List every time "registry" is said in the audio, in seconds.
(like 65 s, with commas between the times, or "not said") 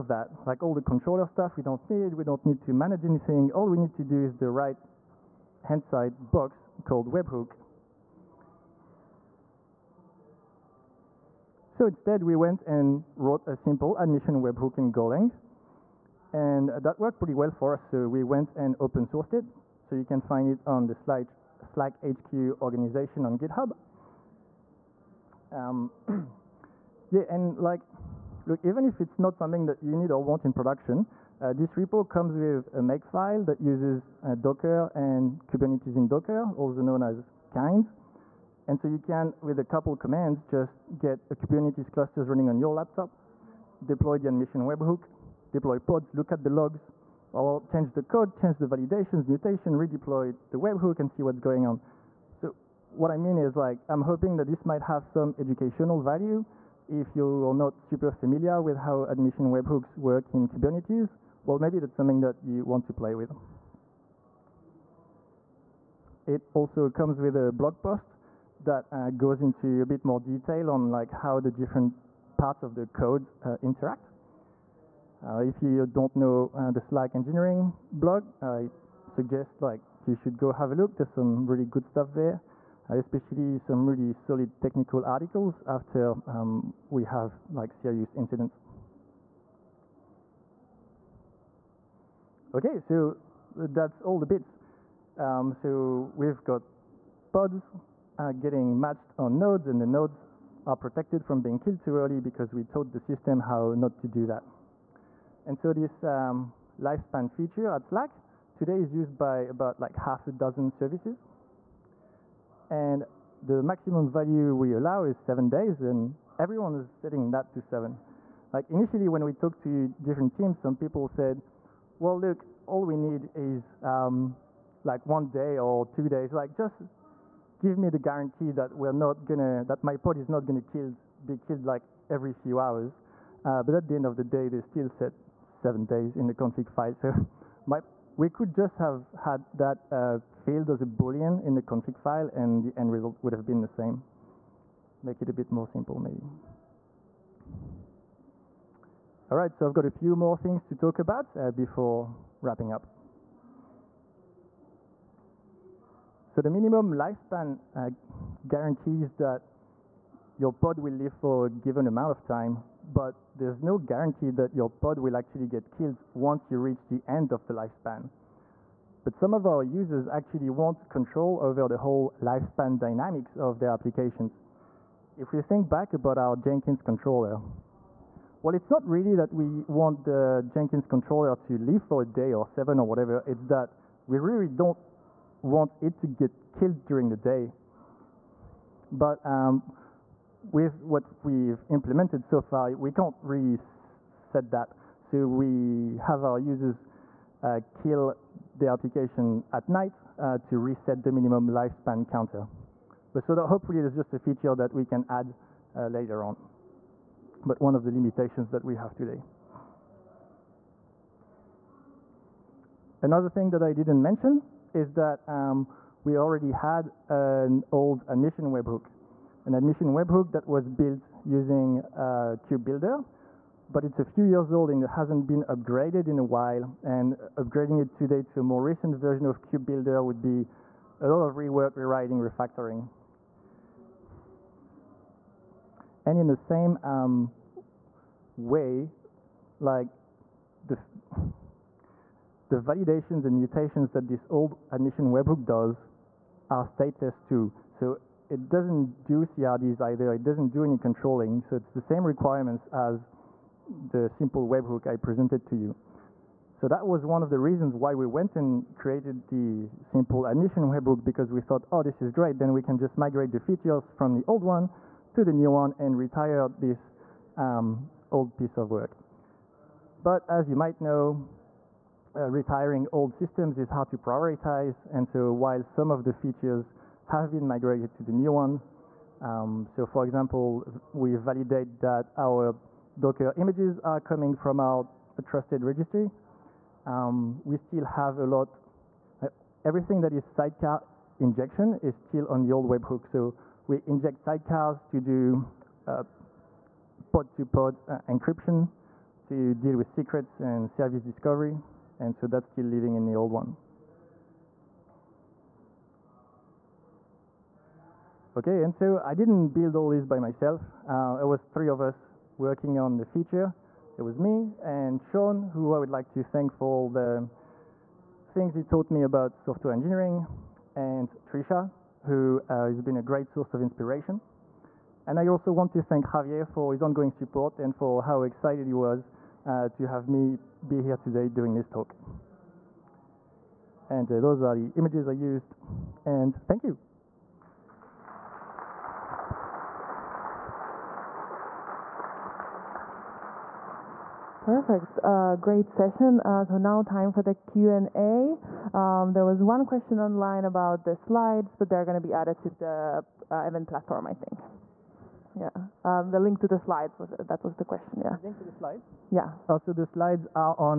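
285 s.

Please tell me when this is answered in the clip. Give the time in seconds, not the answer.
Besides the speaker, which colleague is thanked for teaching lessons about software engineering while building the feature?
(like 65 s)
315 s.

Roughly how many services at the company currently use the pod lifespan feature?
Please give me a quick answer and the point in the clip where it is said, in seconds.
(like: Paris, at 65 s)
half a dozen, at 109 s.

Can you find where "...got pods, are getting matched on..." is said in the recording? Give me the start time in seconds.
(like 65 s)
96 s.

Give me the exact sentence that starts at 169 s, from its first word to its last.
But some of our users actually want control over the whole lifespan dynamics of their applications.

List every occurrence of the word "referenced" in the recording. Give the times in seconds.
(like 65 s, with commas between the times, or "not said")
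not said.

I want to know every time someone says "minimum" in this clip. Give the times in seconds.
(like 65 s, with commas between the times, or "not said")
156 s, 201 s.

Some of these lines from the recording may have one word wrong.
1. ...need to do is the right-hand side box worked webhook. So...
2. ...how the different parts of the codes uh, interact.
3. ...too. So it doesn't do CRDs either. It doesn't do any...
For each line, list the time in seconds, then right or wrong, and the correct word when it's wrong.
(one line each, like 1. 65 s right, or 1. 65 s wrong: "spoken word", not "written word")
1. 3 s wrong: "called", not "worked"
2. 71 s right
3. 247 s right.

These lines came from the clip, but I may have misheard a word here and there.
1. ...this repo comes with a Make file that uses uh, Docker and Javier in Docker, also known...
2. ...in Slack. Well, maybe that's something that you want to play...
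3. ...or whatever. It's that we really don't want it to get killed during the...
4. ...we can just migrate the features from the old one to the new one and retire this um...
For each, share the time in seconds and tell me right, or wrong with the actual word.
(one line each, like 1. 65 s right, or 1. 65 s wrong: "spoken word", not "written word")
1. 31 s wrong: "Kubernetes", not "Javier"
2. 60 s wrong: "Kubernetes", not "Slack"
3. 182 s right
4. 262 s right.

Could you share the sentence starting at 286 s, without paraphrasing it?
Um, we still have a lot, uh, everything that is sidecar injection is still on the old webhook.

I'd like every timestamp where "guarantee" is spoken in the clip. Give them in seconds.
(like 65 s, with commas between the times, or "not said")
127 s, 158 s, 163 s.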